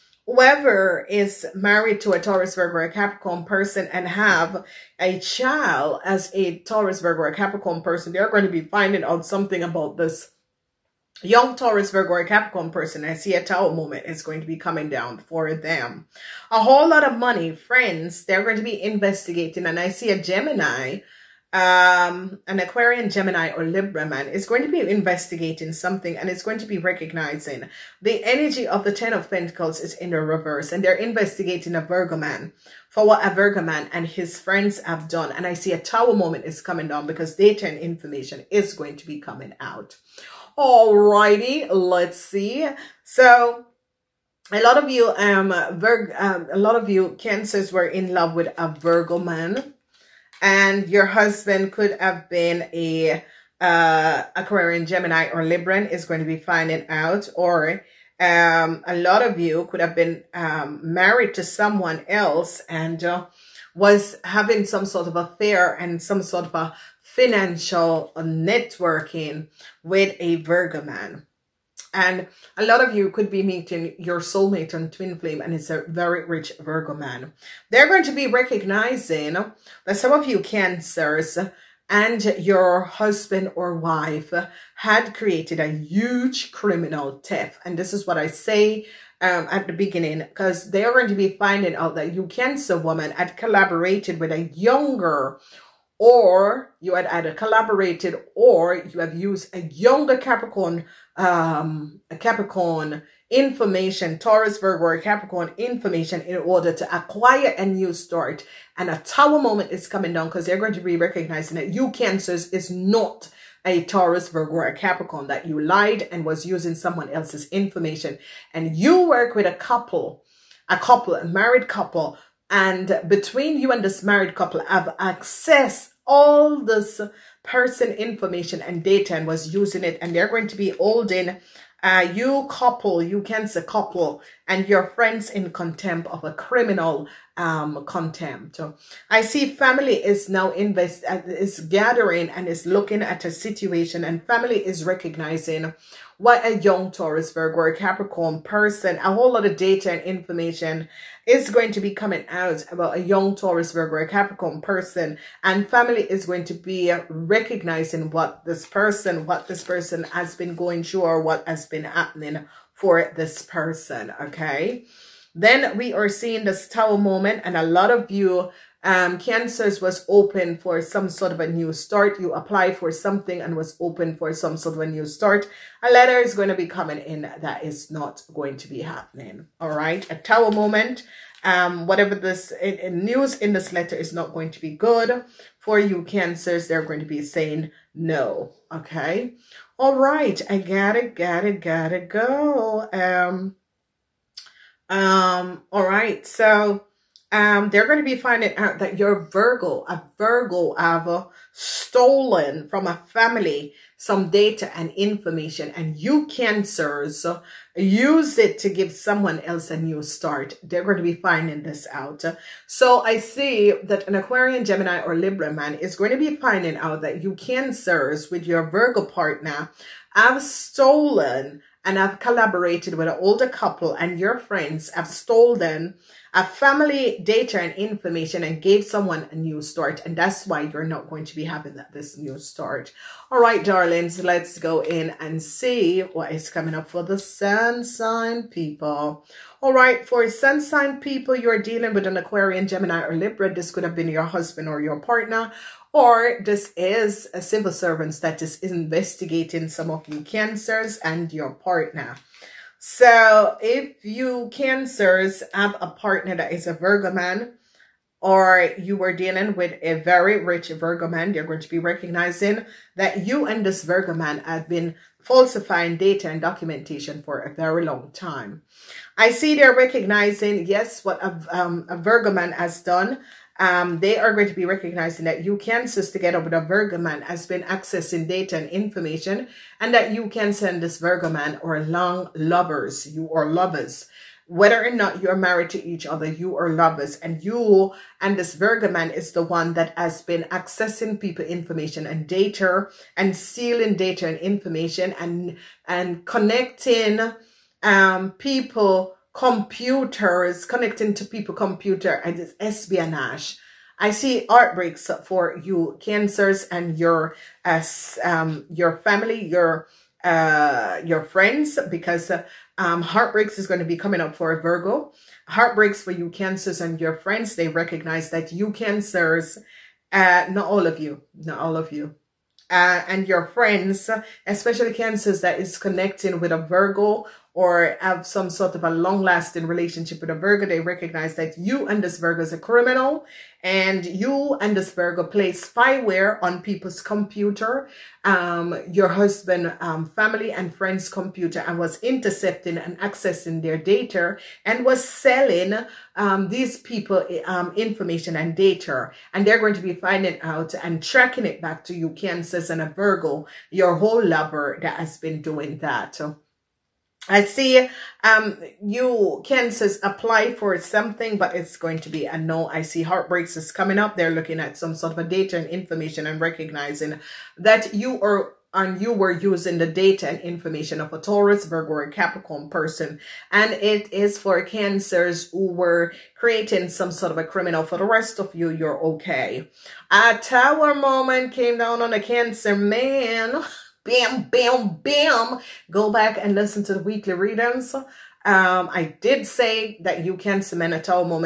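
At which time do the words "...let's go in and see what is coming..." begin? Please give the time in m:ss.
3:54.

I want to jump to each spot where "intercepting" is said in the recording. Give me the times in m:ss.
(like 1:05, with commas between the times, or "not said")
5:41.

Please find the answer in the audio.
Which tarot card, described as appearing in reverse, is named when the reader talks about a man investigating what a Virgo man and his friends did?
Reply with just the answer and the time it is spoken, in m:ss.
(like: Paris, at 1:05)
Ten of Pentacles, at 0:28.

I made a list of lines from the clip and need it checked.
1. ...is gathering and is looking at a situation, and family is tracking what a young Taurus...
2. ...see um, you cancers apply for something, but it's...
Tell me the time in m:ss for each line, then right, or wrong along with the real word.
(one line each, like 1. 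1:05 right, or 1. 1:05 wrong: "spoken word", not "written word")
1. 2:21 wrong: "recognizing", not "tracking"
2. 5:57 right.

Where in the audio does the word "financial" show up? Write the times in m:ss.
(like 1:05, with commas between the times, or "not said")
1:07.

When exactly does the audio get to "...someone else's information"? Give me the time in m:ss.
1:56.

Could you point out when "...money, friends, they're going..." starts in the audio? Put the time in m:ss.
0:17.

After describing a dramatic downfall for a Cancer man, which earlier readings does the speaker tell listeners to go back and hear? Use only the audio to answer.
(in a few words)
weekly readings.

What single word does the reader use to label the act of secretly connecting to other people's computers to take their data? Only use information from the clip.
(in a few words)
espionage.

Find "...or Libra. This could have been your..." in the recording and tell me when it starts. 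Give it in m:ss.
4:03.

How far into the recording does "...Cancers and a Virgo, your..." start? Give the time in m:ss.
5:52.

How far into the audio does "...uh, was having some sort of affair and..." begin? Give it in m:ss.
1:03.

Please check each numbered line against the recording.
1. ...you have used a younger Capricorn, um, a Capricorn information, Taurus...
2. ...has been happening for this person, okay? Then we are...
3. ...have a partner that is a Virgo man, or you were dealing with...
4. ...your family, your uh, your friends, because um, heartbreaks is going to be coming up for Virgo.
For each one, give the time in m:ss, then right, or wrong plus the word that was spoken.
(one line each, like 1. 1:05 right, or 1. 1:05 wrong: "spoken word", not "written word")
1. 1:38 right
2. 2:41 right
3. 4:15 right
4. 5:08 right.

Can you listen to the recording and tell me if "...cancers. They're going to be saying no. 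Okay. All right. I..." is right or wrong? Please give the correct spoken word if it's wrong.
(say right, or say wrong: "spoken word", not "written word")
right.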